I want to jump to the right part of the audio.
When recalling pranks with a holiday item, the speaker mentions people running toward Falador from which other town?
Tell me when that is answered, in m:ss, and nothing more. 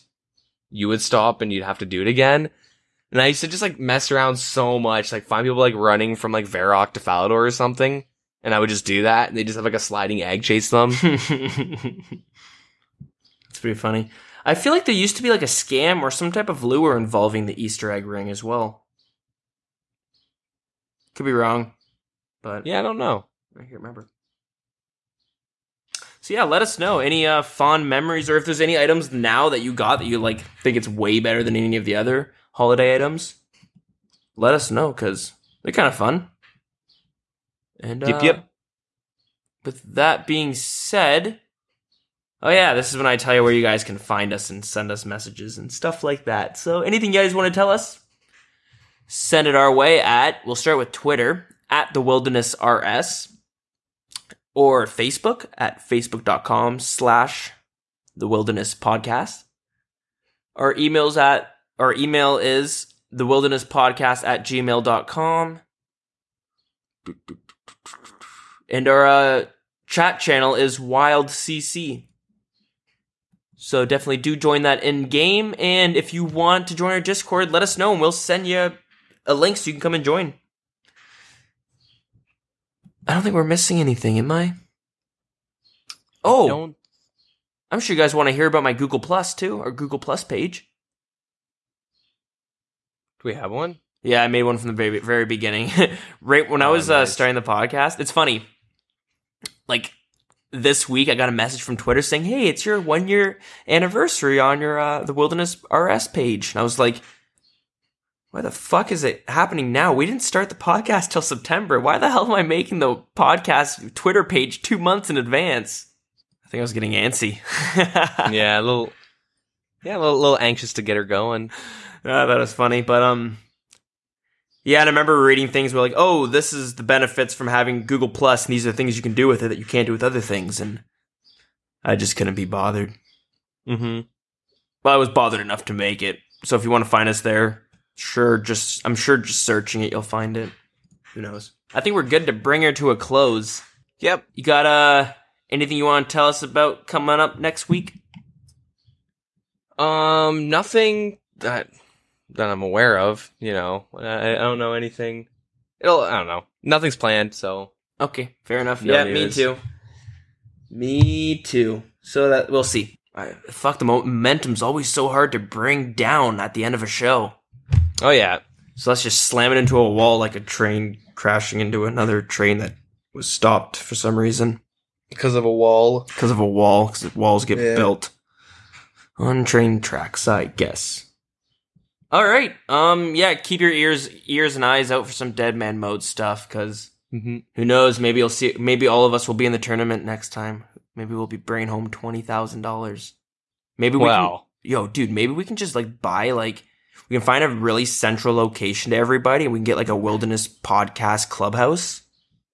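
0:06.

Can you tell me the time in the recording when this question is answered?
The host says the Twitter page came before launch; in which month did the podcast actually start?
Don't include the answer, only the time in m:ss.
1:51.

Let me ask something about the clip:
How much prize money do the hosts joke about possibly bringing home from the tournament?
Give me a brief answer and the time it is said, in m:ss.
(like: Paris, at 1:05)
$20,000, at 3:11.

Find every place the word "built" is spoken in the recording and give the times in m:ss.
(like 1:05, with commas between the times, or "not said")
2:57.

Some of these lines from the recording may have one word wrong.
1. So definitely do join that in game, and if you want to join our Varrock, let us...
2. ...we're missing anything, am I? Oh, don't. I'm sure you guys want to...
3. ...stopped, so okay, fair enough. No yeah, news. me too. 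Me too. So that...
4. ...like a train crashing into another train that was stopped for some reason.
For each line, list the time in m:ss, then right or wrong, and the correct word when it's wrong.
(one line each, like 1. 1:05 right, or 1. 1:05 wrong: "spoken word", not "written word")
1. 1:13 wrong: "Discord", not "Varrock"
2. 1:23 right
3. 2:36 wrong: "planned", not "stopped"
4. 2:50 right.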